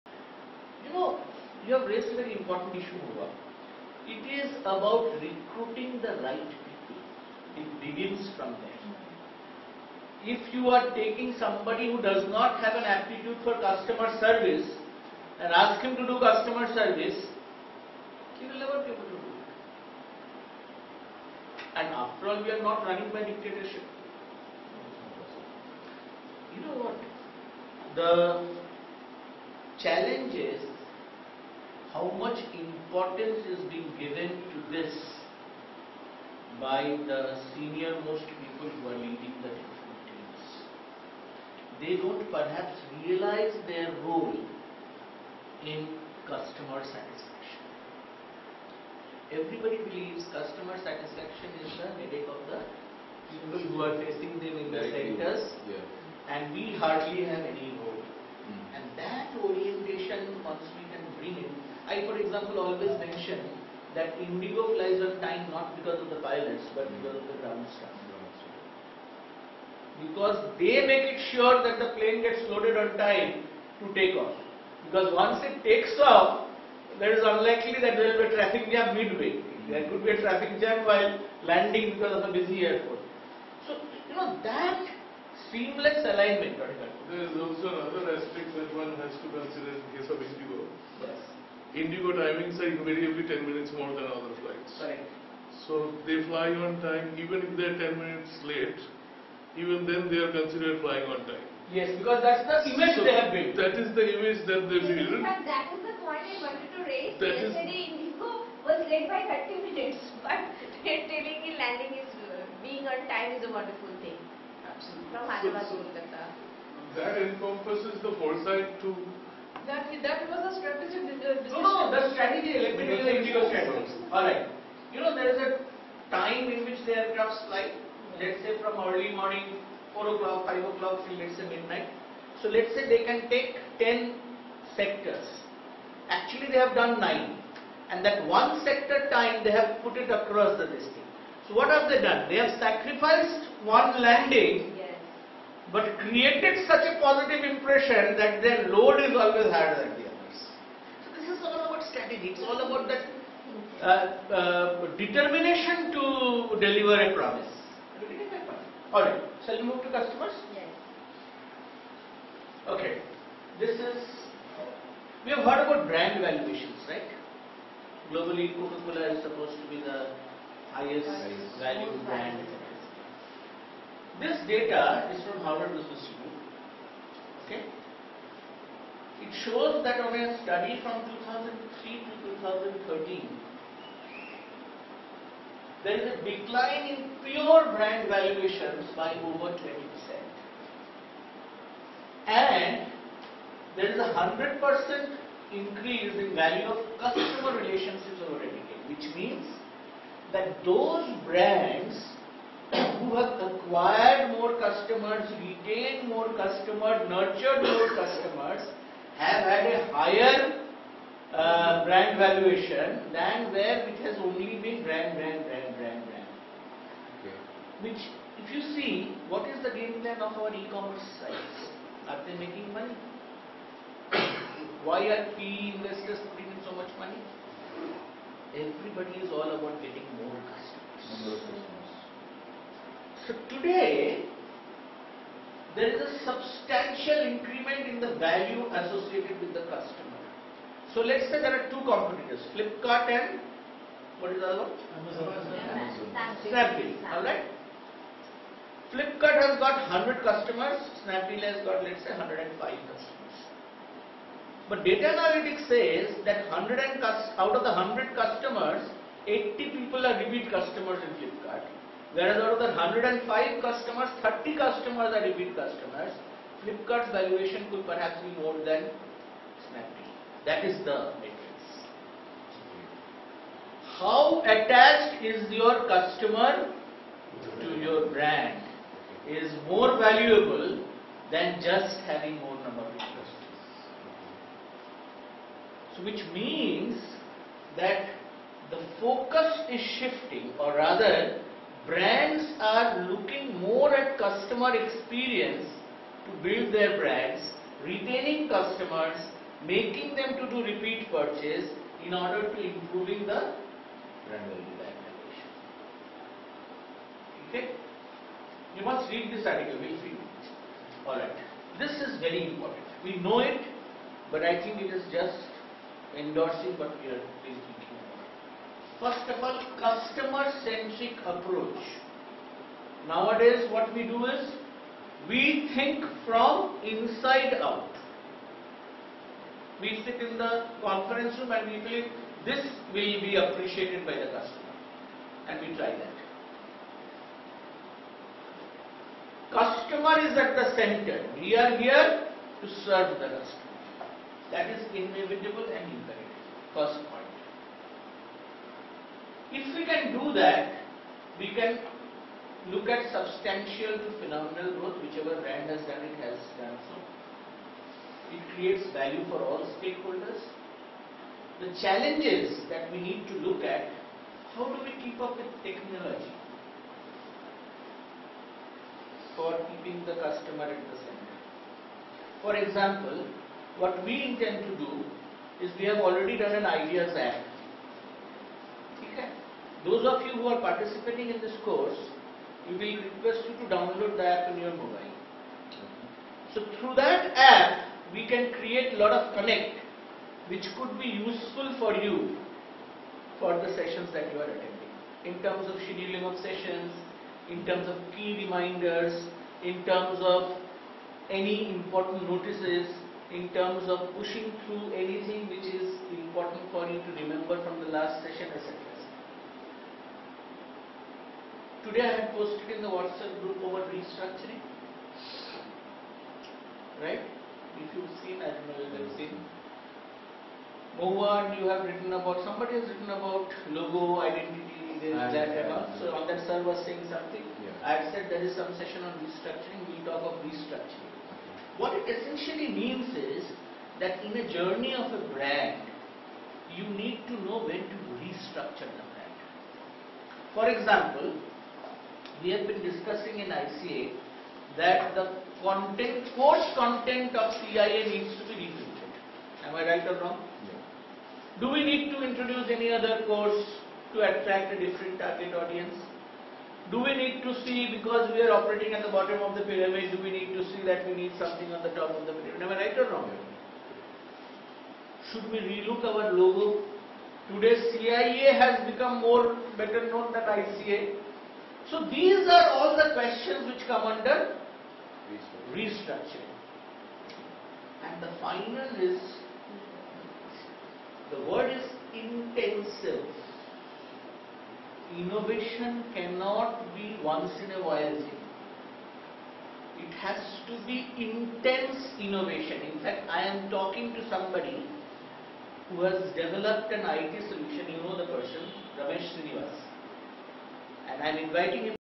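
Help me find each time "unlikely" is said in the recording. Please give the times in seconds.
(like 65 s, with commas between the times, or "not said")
77 s.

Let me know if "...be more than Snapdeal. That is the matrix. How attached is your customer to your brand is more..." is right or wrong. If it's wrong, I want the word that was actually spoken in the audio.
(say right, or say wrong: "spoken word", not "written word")
right.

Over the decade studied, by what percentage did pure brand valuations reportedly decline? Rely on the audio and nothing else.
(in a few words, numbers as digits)
over 20%.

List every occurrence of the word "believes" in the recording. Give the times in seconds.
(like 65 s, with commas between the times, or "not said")
49 s, 331 s.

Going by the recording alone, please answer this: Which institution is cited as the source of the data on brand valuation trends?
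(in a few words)
Harvard Business School.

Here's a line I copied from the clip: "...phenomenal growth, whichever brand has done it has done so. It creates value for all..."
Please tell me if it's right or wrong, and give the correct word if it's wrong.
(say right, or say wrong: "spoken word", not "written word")
right.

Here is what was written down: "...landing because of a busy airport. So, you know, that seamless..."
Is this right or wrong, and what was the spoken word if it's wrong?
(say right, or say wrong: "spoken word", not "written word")
right.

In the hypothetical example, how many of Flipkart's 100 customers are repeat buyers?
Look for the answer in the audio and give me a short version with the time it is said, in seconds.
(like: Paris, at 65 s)
80, at 259 s.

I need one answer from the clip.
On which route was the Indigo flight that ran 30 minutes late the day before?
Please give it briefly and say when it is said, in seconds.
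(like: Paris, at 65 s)
Hyderabad to Kolkata, at 115 s.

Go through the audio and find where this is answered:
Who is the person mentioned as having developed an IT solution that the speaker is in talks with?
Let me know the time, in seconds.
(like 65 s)
498 s.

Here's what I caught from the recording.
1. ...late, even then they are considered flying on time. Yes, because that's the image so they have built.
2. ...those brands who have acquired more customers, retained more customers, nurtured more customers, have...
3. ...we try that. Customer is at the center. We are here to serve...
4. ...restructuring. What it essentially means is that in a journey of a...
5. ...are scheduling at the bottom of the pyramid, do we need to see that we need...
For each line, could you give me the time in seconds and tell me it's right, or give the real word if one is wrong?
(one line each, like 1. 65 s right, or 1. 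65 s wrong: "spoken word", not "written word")
1. 98 s right
2. 200 s right
3. 335 s right
4. 430 s right
5. 458 s wrong: "operating", not "scheduling".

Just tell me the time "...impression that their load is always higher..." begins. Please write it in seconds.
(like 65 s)
147 s.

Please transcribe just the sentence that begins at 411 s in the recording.
Today I am posted in the WhatsApp group about restructuring.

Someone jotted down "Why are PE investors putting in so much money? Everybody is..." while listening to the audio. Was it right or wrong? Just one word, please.
right.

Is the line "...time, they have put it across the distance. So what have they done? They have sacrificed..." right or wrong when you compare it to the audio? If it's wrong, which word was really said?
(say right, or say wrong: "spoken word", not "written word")
right.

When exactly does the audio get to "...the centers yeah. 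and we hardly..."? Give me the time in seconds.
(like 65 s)
54 s.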